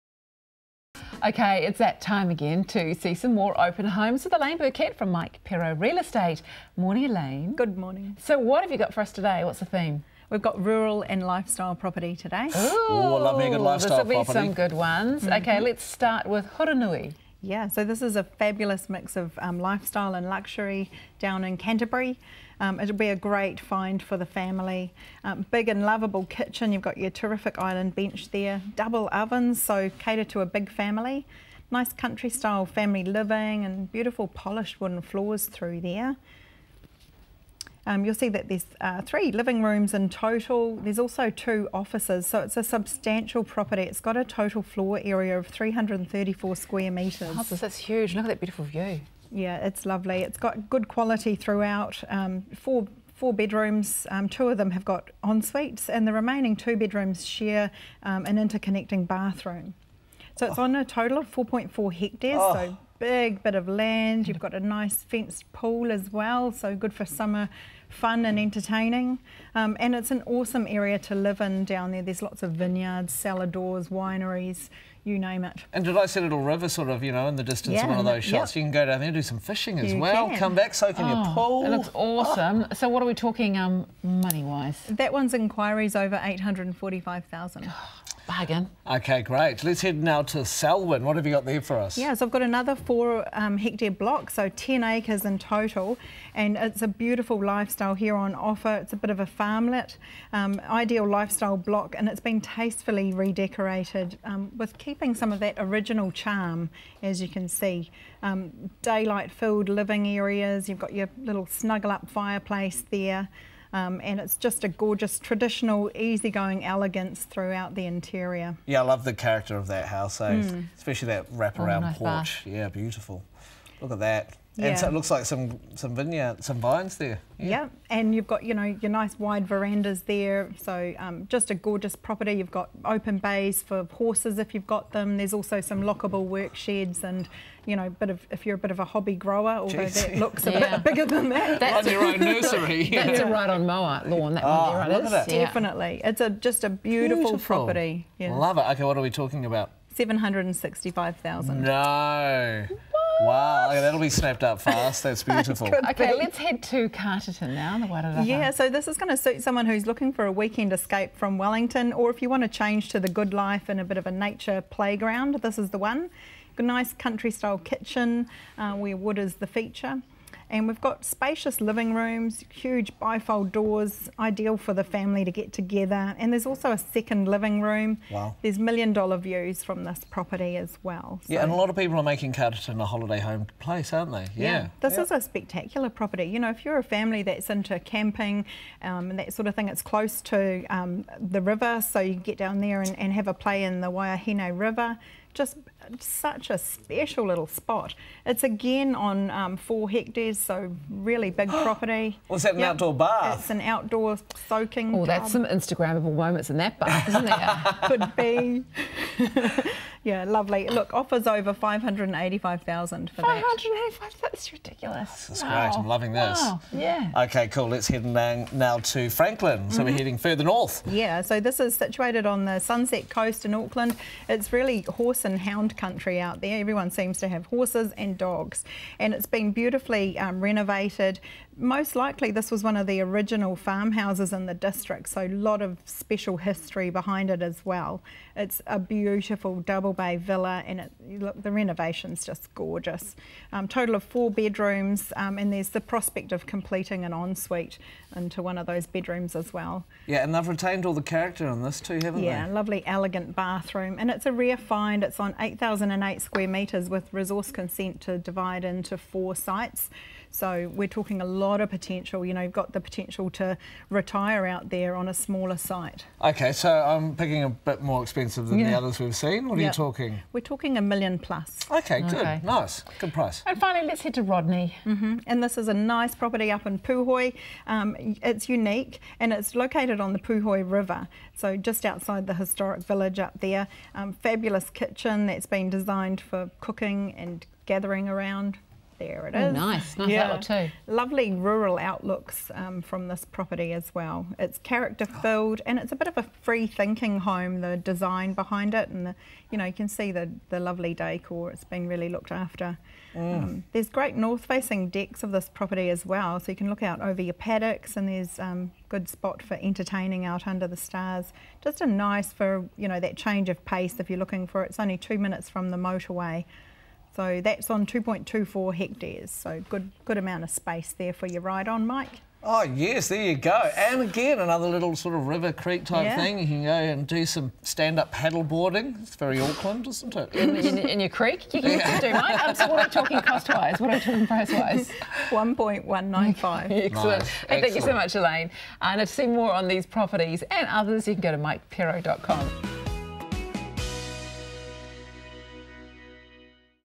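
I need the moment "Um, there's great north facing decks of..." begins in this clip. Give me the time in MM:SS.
05:03.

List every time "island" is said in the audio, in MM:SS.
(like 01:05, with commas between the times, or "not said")
00:27.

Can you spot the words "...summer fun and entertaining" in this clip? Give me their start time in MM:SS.
01:07.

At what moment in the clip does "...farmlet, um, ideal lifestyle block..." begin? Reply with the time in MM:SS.
01:39.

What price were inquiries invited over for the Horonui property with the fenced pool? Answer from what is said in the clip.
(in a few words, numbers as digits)
845,000.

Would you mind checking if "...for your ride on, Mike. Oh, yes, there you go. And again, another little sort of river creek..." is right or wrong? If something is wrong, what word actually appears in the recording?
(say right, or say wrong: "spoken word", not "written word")
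right.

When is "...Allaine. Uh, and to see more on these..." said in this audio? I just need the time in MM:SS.
05:38.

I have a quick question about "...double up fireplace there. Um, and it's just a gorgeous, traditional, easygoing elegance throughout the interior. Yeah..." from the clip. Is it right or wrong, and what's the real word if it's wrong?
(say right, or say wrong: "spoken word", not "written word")
wrong: "snuggle", not "double".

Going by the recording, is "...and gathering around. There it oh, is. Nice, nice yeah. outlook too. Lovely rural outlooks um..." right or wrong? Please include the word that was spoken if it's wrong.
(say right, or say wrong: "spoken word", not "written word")
right.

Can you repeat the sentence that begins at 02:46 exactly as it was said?
a nice country style kitchen uh, where wood is the feature.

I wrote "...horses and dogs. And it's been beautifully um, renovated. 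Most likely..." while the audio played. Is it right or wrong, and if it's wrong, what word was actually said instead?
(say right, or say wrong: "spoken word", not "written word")
right.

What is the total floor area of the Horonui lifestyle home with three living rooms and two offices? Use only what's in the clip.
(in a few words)
334 square metres.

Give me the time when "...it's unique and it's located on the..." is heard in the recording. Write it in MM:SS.
04:38.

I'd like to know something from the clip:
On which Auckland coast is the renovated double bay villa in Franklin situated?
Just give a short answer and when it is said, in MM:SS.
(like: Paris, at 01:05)
Sunset Coast, at 03:42.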